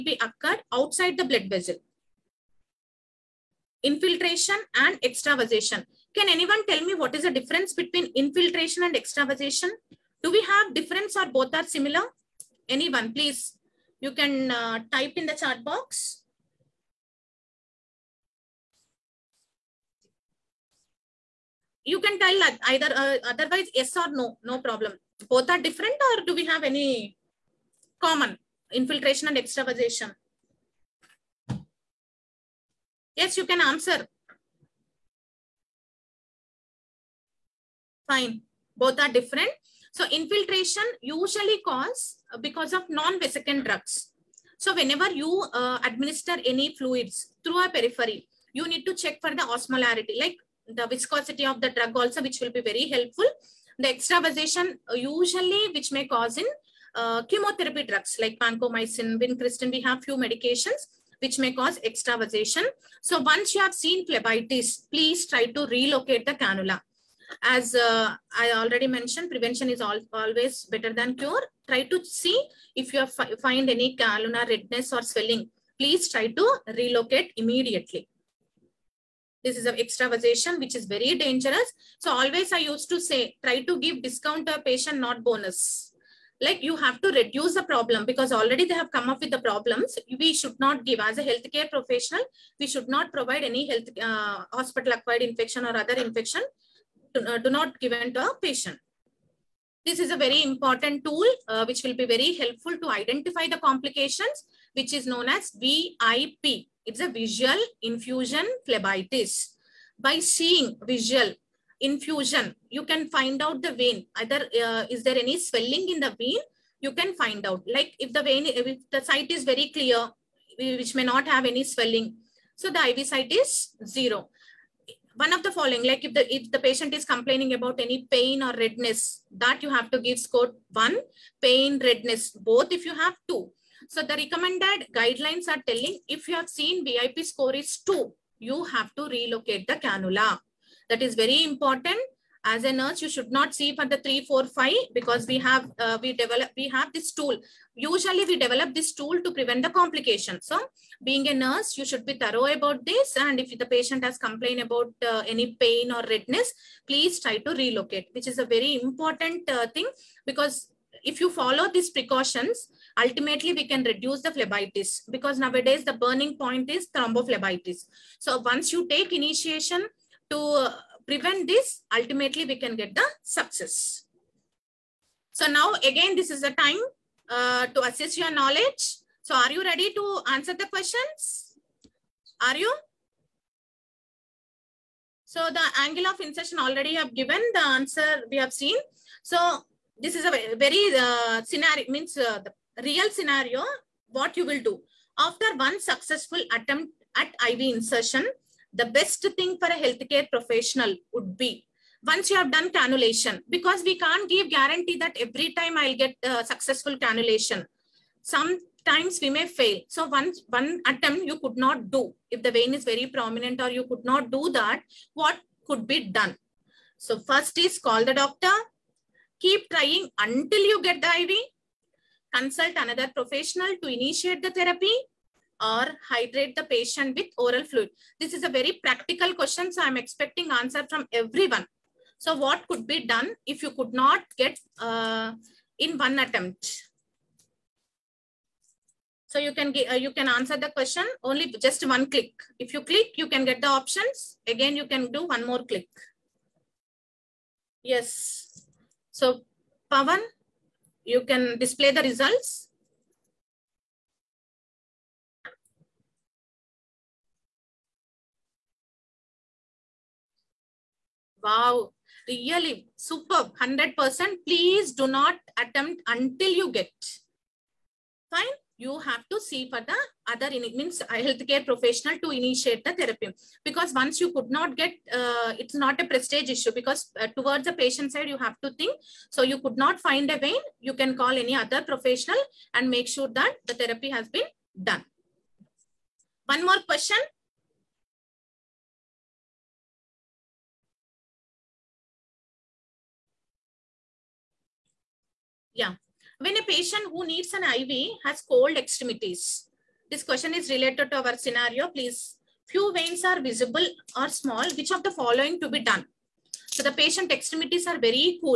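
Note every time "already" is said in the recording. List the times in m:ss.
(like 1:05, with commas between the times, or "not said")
1:08, 1:28, 3:06.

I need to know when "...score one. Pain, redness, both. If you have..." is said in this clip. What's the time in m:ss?
2:10.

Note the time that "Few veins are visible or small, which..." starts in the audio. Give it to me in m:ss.
5:02.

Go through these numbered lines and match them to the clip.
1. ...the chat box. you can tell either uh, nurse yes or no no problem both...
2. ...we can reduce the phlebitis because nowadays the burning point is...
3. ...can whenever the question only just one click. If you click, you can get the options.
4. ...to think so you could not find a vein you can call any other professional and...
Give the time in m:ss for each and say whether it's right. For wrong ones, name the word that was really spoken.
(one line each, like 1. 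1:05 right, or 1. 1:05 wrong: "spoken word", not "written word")
1. 0:15 wrong: "otherwise", not "nurse"
2. 2:43 right
3. 4:00 wrong: "answer", not "whenever"
4. 4:38 right.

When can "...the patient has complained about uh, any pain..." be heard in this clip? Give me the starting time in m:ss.
2:33.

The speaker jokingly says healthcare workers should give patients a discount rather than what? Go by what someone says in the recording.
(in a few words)
Bonus.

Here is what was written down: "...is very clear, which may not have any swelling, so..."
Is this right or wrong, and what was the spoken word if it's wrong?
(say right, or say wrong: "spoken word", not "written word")
right.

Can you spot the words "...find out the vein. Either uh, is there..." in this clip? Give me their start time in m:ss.
1:53.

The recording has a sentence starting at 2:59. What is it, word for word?
So are you ready to answer the questions?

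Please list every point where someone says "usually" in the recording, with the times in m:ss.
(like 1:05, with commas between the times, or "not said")
0:41, 0:54, 2:27.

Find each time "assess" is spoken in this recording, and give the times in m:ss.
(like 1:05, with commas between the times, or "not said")
2:57.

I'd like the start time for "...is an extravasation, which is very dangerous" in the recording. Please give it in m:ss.
1:19.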